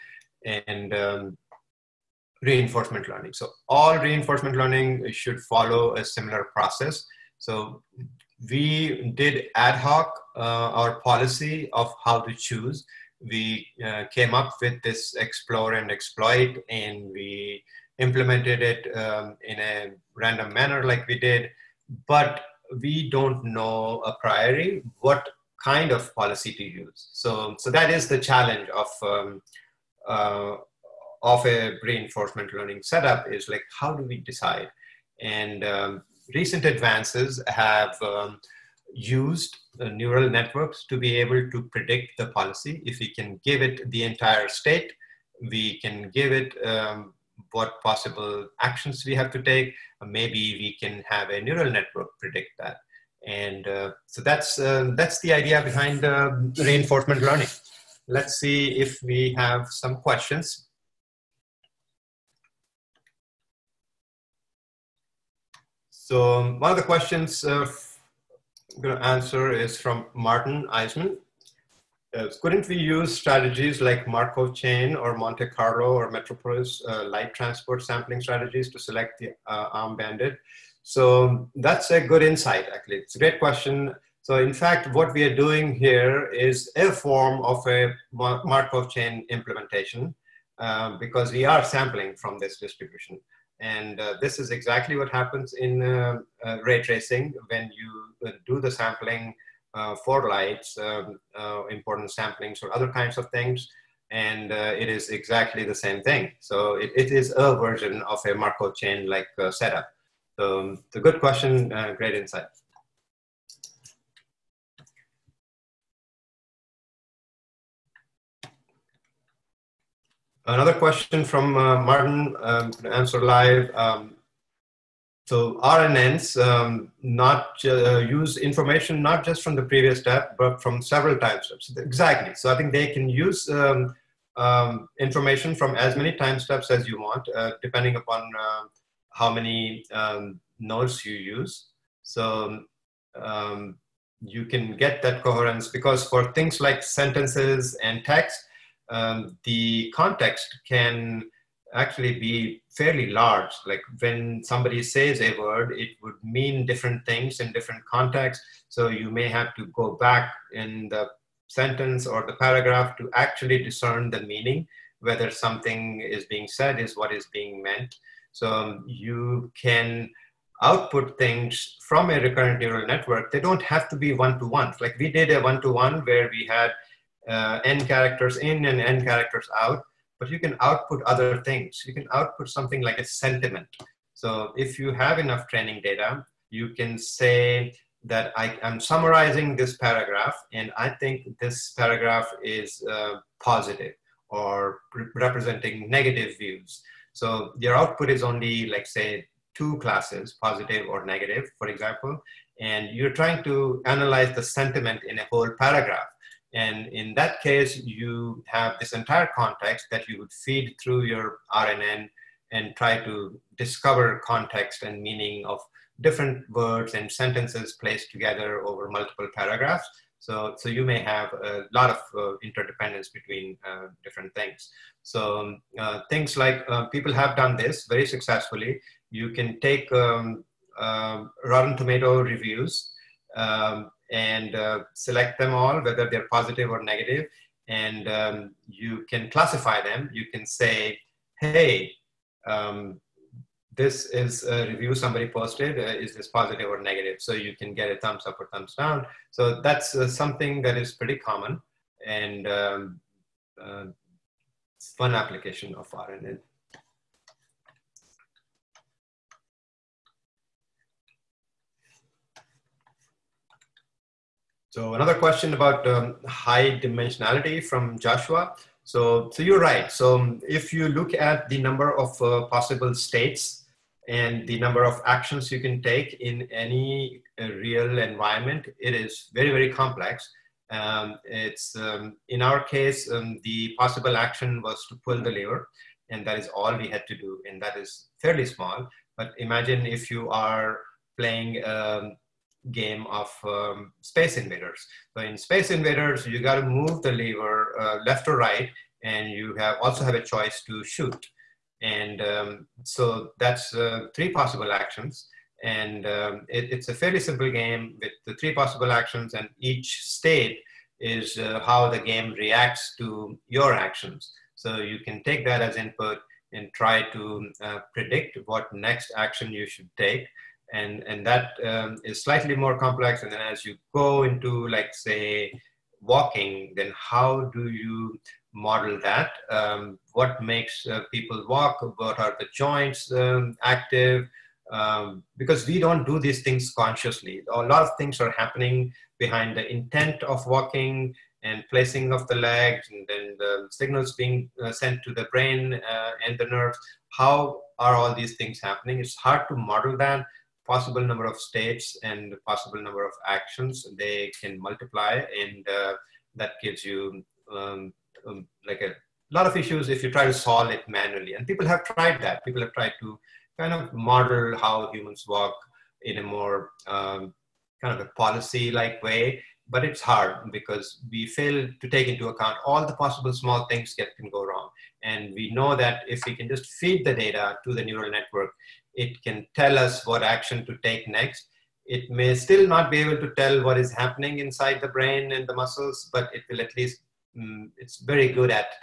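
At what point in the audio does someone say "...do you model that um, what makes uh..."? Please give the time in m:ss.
5:27.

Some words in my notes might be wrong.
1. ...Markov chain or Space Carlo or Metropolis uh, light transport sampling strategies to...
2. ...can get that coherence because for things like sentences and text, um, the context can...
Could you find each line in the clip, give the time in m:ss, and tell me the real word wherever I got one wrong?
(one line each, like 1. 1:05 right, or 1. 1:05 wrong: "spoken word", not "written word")
1. 1:14 wrong: "Monte", not "Space"
2. 2:24 right.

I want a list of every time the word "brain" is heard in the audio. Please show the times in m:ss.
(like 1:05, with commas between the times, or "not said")
5:45, 6:24.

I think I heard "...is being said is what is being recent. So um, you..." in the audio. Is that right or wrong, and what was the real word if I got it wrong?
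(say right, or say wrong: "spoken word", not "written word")
wrong: "meant", not "recent".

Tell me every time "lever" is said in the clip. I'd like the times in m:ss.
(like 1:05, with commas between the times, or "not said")
4:45, 4:57.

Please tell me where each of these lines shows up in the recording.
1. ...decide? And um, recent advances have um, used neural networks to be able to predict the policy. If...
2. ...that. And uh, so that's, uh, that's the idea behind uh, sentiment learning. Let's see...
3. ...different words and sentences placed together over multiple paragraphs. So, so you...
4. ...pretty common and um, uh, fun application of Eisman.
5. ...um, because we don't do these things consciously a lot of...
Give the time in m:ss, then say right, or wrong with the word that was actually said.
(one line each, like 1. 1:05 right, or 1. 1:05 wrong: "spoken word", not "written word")
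1. 0:34 right
2. 0:52 wrong: "reinforcement", not "sentiment"
3. 3:36 right
4. 4:10 wrong: "RNN", not "Eisman"
5. 5:34 right.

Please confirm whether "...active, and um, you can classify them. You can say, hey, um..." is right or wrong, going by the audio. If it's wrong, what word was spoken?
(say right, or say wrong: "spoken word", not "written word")
wrong: "negative", not "active".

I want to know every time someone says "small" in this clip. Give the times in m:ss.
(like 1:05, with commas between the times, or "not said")
4:48, 6:13.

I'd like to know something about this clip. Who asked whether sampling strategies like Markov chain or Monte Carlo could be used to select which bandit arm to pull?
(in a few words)
Martin Eisman.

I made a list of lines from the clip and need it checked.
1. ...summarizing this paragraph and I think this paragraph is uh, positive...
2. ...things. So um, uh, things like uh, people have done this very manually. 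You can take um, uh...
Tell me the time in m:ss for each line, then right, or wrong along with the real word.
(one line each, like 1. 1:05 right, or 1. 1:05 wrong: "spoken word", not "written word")
1. 3:08 right
2. 3:44 wrong: "successfully", not "manually".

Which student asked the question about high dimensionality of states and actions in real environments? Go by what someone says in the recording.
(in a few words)
Joshua.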